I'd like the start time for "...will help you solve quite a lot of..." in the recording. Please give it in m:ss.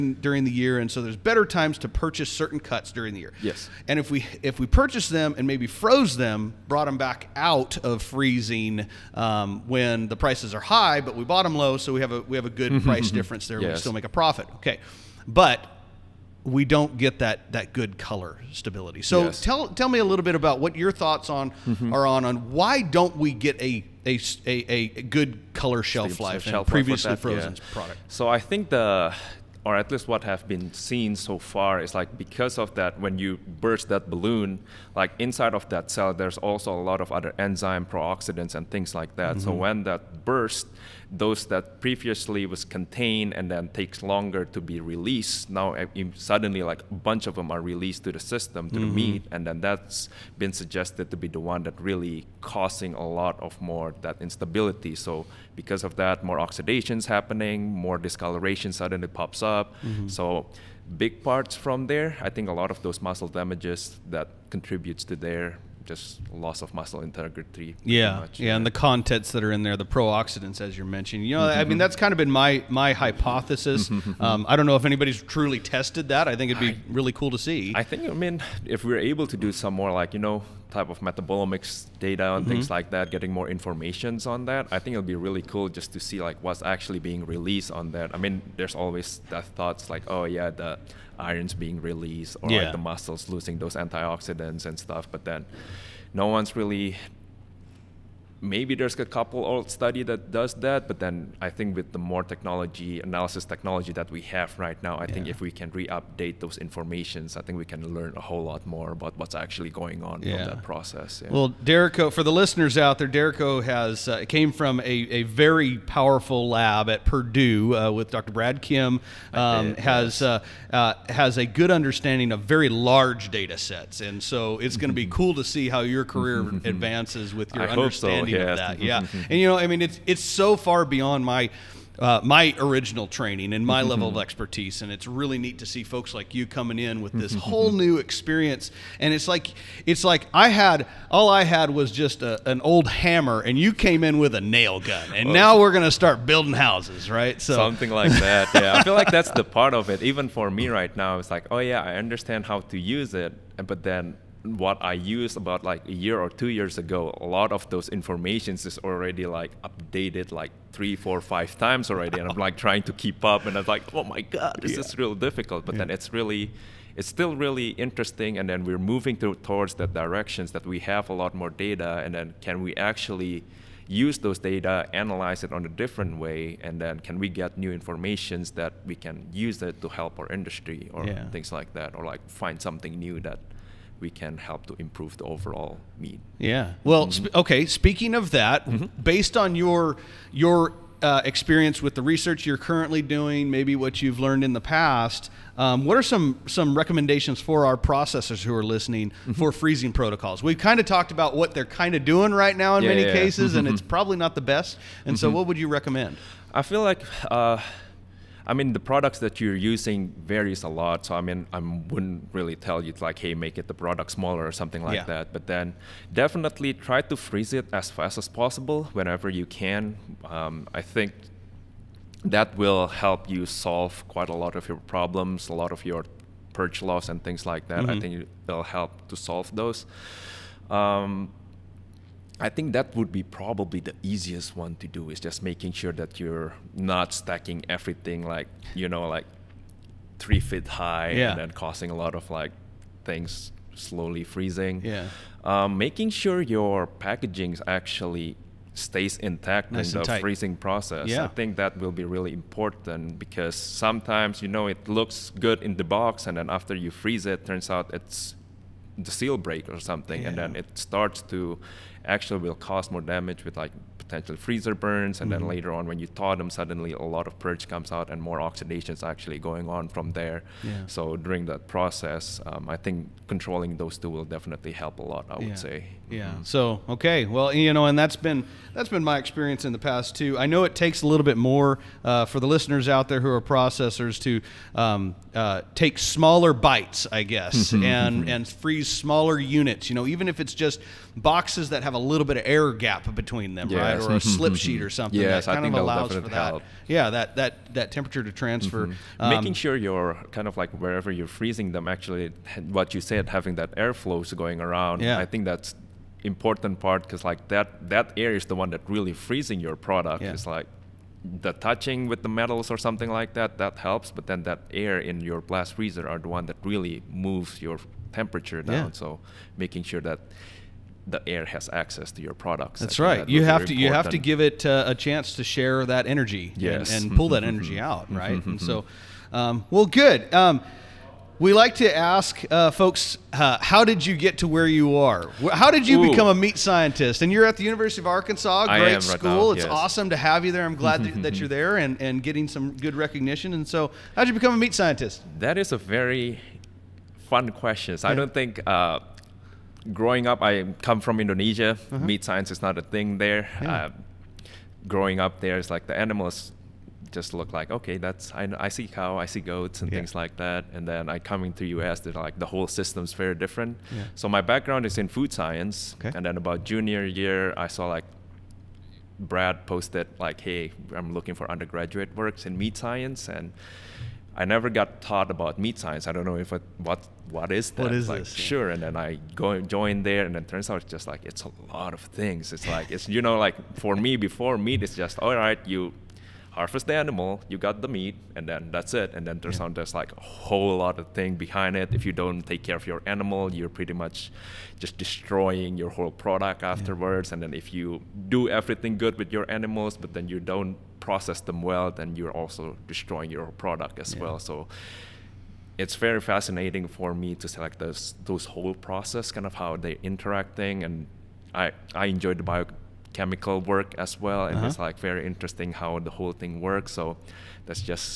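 3:42.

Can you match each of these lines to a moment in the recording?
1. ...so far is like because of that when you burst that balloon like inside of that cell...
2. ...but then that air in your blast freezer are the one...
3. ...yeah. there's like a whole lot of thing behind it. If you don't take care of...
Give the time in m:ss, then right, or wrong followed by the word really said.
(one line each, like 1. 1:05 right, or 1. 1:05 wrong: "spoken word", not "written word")
1. 0:31 right
2. 5:14 right
3. 6:29 right.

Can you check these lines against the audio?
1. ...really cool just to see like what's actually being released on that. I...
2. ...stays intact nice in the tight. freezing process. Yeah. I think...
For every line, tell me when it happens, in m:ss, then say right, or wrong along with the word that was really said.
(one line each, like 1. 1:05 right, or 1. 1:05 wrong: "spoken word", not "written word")
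1. 1:25 right
2. 4:08 right.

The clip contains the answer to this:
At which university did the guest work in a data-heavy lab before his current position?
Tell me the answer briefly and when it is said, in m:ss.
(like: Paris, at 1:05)
Purdue, at 1:57.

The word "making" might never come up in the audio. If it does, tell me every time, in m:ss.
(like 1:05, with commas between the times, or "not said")
3:55, 4:05, 4:59, 5:19.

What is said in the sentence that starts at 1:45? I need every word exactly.
think if we can re-update those informations, I think we can learn a whole lot more about what's actually going on yeah.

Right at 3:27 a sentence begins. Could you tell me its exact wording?
Uh I mean, the products that you're using varies a lot.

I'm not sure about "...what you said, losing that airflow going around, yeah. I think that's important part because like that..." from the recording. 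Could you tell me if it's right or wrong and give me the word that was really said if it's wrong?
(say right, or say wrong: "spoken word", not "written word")
wrong: "having", not "losing".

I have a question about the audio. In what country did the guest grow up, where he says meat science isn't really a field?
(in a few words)
Indonesia.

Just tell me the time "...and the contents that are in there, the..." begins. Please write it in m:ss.
1:08.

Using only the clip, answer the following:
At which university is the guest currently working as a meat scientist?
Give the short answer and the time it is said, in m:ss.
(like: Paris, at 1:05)
University of Arkansas, at 5:37.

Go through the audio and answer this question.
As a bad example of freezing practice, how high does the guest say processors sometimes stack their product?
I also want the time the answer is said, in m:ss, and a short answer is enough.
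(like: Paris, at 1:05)
3 feet, at 4:00.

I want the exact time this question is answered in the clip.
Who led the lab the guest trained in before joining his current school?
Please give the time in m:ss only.
1:58.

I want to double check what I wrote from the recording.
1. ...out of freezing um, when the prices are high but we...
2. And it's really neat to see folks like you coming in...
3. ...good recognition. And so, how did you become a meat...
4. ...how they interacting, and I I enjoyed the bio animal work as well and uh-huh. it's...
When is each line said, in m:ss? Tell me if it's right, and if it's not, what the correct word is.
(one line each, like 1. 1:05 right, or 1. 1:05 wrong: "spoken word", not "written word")
1. 0:07 right
2. 2:14 right
3. 5:42 right
4. 6:49 wrong: "chemical", not "animal".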